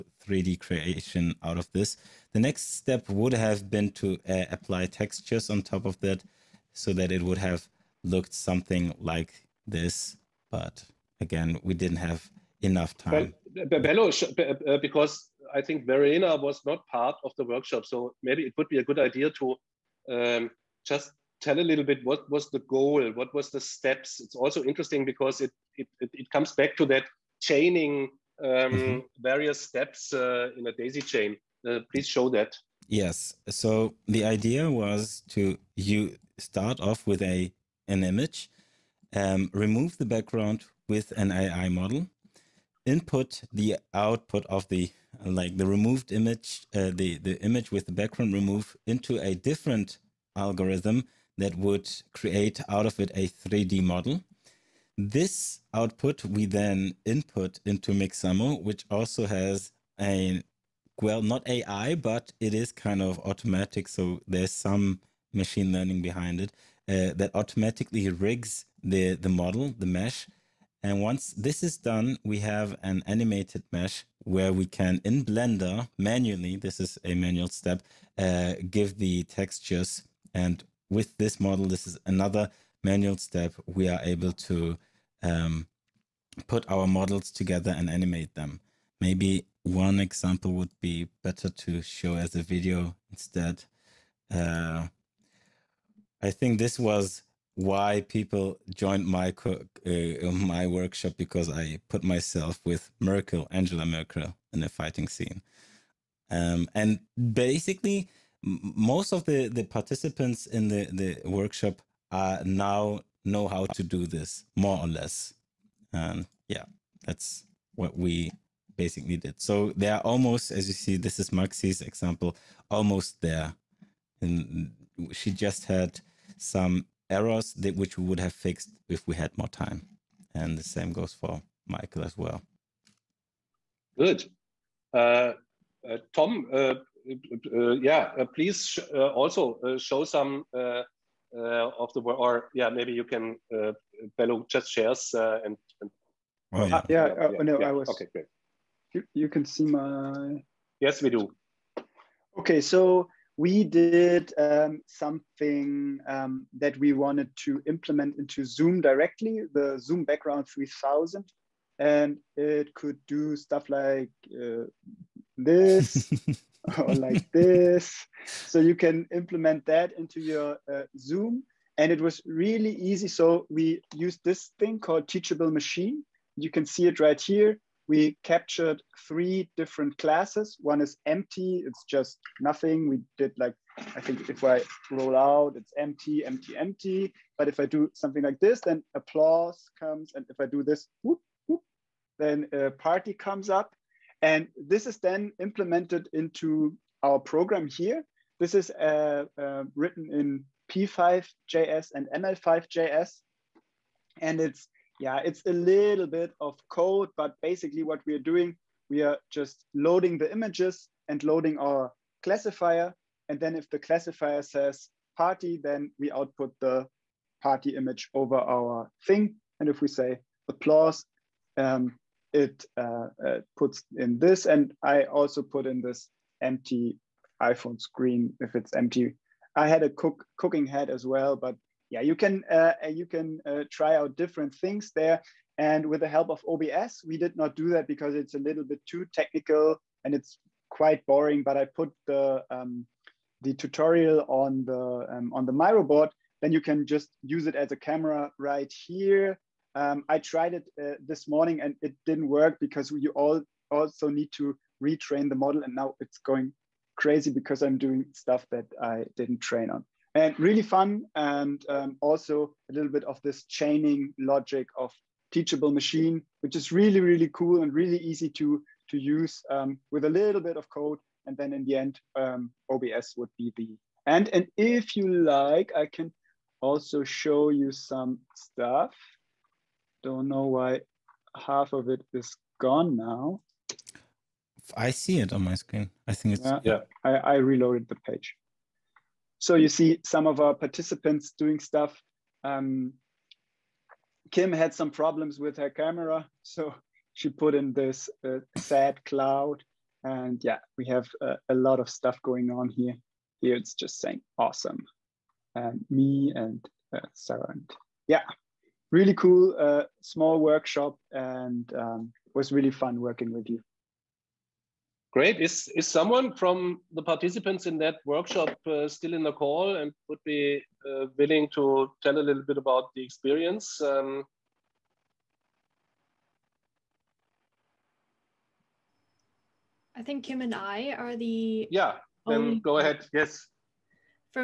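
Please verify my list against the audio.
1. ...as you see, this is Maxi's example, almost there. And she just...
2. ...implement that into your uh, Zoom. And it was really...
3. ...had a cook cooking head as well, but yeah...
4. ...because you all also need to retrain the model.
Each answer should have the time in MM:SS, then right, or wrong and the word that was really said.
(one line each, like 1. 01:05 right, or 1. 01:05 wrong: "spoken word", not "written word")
1. 02:00 right
2. 02:49 right
3. 03:49 right
4. 04:12 right.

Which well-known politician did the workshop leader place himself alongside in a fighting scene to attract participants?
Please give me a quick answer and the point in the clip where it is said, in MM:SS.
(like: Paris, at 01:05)
Angela Merkel, at 01:43.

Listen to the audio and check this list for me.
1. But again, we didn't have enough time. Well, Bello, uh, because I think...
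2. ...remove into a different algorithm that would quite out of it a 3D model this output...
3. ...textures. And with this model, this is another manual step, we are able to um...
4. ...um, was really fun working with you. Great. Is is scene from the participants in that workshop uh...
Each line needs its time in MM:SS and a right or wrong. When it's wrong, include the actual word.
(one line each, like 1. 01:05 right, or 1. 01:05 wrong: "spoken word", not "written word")
1. 00:10 right
2. 00:48 wrong: "create", not "quite"
3. 01:19 right
4. 05:11 wrong: "someone", not "scene".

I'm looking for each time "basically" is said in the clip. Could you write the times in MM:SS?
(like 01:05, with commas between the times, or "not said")
01:47, 01:58, 03:27.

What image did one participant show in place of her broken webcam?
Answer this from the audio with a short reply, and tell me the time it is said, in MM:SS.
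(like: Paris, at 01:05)
sad cloud, at 04:58.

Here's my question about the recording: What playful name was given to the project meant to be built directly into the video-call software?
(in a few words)
Zoom Background 3000.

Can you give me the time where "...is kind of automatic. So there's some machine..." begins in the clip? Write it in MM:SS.
01:02.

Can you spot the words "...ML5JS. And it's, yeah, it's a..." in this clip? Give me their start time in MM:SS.
03:22.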